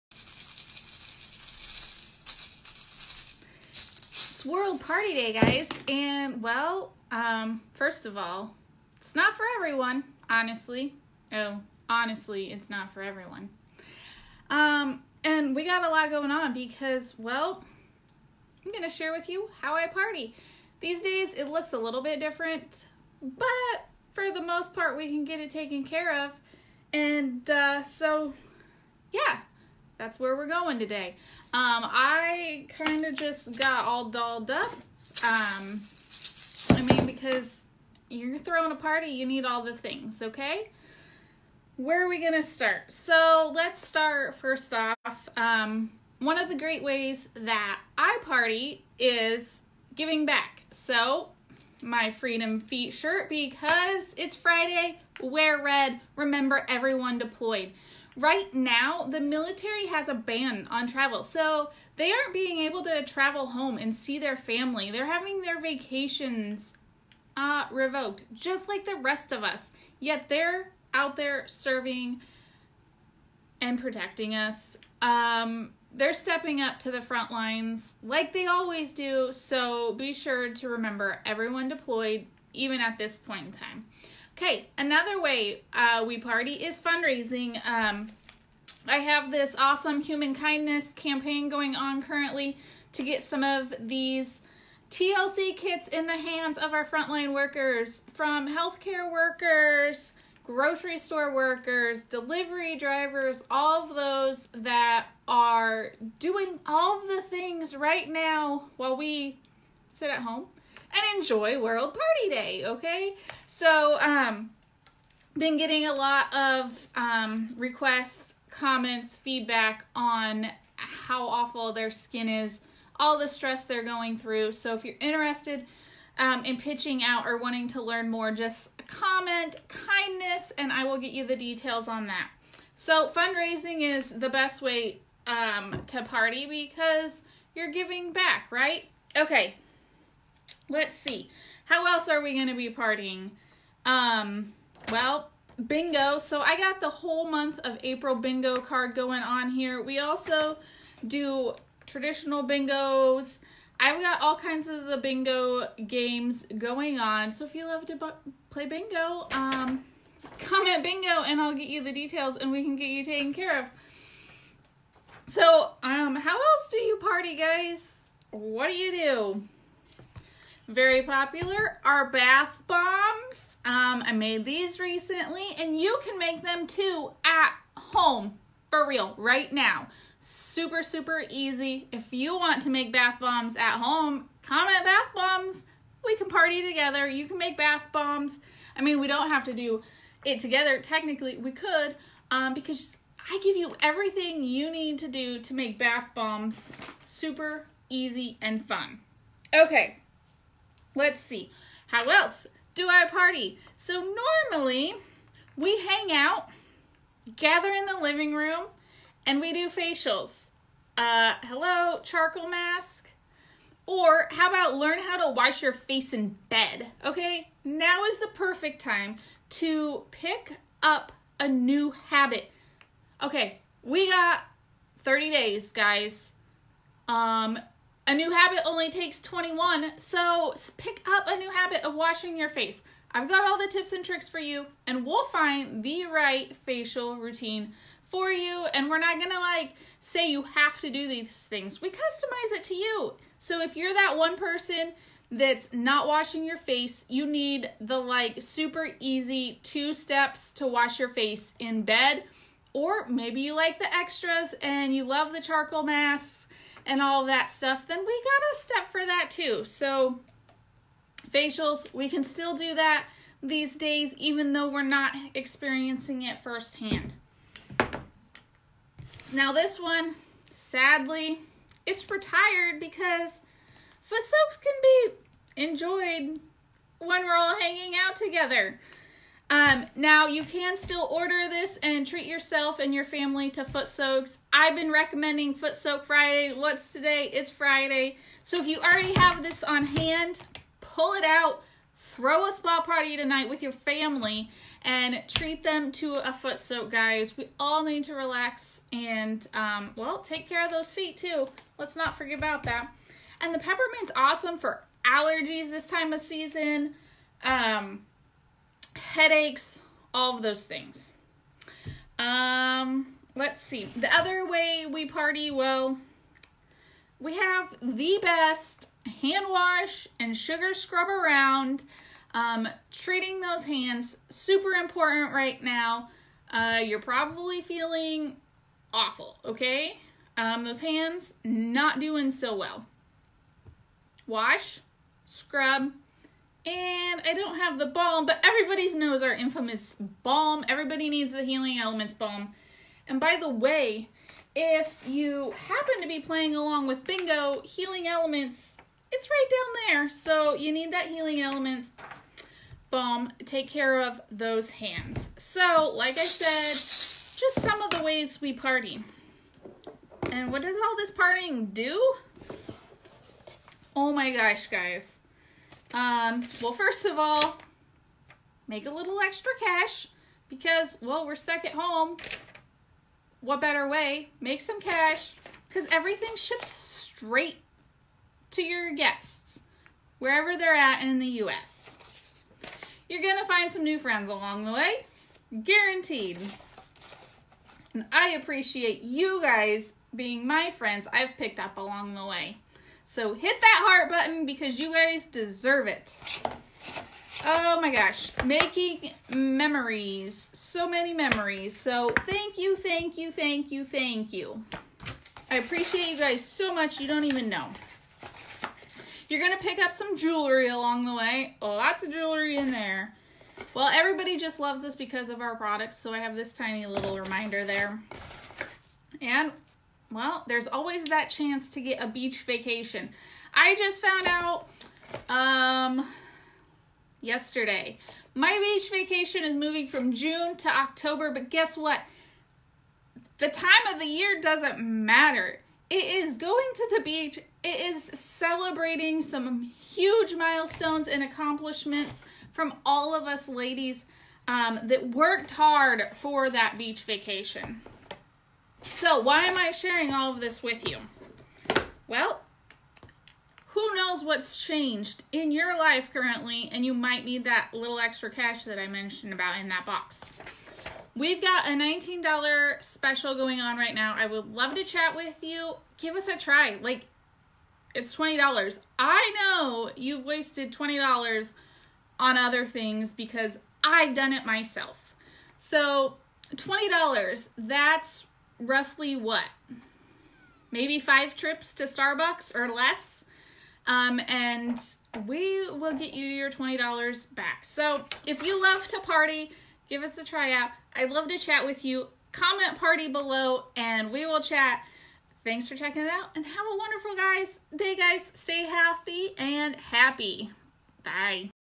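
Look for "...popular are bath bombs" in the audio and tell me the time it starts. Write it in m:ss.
2:51.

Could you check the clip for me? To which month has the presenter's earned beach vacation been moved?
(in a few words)
October.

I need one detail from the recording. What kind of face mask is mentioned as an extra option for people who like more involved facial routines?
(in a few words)
charcoal mask.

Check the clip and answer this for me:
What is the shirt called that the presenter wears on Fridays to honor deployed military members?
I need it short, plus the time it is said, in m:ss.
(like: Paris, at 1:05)
Freedom Feet, at 0:52.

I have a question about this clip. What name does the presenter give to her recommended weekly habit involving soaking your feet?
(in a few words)
Foot Soak Friday.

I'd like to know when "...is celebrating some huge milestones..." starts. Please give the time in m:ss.
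7:17.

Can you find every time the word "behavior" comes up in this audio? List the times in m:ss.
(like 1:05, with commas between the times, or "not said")
not said.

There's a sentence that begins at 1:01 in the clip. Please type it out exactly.
So they aren't being able to travel home and see their family.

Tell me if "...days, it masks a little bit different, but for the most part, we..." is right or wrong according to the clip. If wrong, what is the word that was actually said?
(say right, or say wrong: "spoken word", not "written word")
wrong: "looks", not "masks".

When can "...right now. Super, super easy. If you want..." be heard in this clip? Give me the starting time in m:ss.
2:59.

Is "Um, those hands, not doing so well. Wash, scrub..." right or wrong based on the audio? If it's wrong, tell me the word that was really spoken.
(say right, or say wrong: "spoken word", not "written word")
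right.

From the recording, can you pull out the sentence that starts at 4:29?
Now this one, sadly, it's retired because foot soaks can be enjoyed when we're all hanging out together.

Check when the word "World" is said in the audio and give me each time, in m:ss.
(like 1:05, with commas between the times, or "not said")
0:04, 1:51.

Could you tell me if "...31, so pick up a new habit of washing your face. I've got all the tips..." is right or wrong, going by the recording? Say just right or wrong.
wrong.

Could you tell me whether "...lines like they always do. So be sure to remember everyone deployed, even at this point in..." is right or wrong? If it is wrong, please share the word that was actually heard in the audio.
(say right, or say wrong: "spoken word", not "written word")
right.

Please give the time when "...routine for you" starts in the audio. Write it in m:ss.
3:57.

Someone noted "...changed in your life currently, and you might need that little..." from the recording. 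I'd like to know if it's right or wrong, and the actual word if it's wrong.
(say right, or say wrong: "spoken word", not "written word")
right.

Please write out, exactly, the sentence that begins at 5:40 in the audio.
Everybody needs the Healing Elements balm.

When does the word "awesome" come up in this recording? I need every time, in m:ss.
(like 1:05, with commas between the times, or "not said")
1:29, 5:04.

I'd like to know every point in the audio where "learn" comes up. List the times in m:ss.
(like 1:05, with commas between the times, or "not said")
2:07, 3:34.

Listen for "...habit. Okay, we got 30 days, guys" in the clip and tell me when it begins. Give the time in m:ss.
3:42.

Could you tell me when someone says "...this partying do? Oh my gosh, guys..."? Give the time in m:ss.
6:00.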